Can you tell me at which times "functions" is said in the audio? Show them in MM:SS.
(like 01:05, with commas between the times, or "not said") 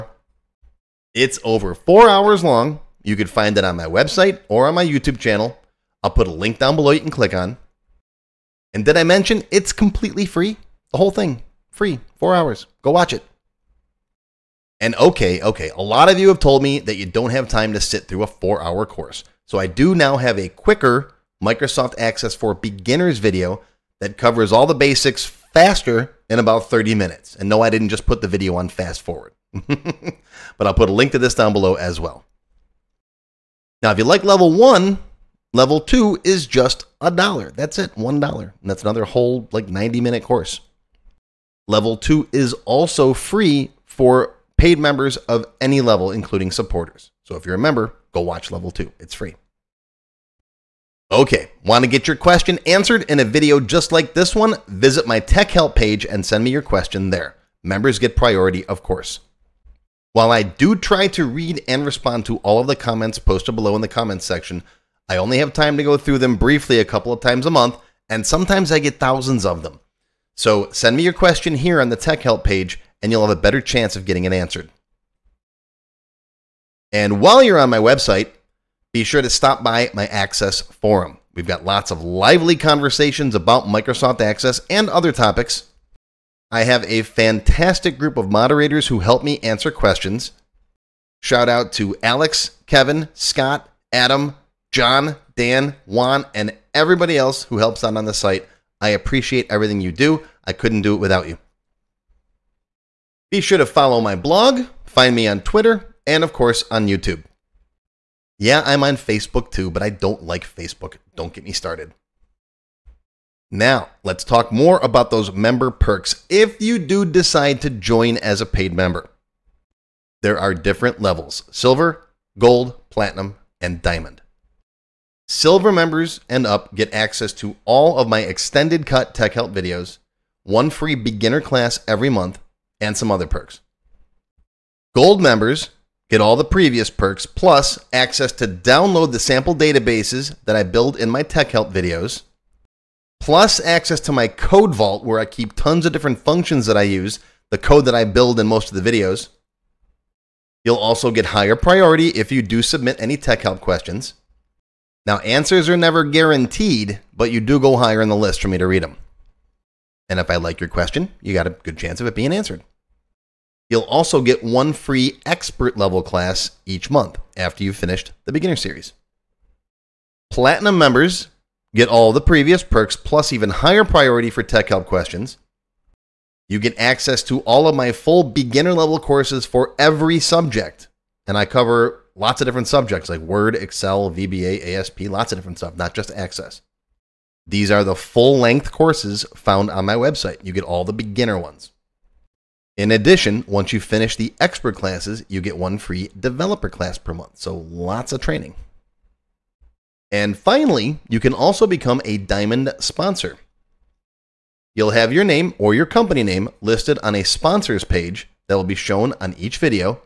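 02:26.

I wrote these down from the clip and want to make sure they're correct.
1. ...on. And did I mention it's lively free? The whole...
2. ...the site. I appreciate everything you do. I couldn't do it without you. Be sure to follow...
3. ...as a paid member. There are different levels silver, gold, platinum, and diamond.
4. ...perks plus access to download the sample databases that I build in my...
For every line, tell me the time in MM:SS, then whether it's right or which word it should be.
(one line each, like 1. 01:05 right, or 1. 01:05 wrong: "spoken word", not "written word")
1. 00:07 wrong: "completely", not "lively"
2. 01:38 right
3. 01:58 right
4. 02:16 right.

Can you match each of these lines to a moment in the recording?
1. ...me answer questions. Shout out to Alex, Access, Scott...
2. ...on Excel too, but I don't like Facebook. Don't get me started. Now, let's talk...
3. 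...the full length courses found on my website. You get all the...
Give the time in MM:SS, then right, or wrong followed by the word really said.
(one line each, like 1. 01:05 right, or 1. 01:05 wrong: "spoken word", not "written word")
1. 01:29 wrong: "Kevin", not "Access"
2. 01:48 wrong: "Facebook", not "Excel"
3. 03:07 right.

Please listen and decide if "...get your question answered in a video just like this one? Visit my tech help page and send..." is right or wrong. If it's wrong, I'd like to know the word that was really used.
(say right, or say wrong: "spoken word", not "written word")
right.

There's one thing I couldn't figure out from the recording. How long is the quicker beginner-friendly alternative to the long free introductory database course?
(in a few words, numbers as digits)
30 minutes.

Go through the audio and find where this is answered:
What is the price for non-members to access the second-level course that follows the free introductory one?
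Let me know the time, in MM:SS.
00:37.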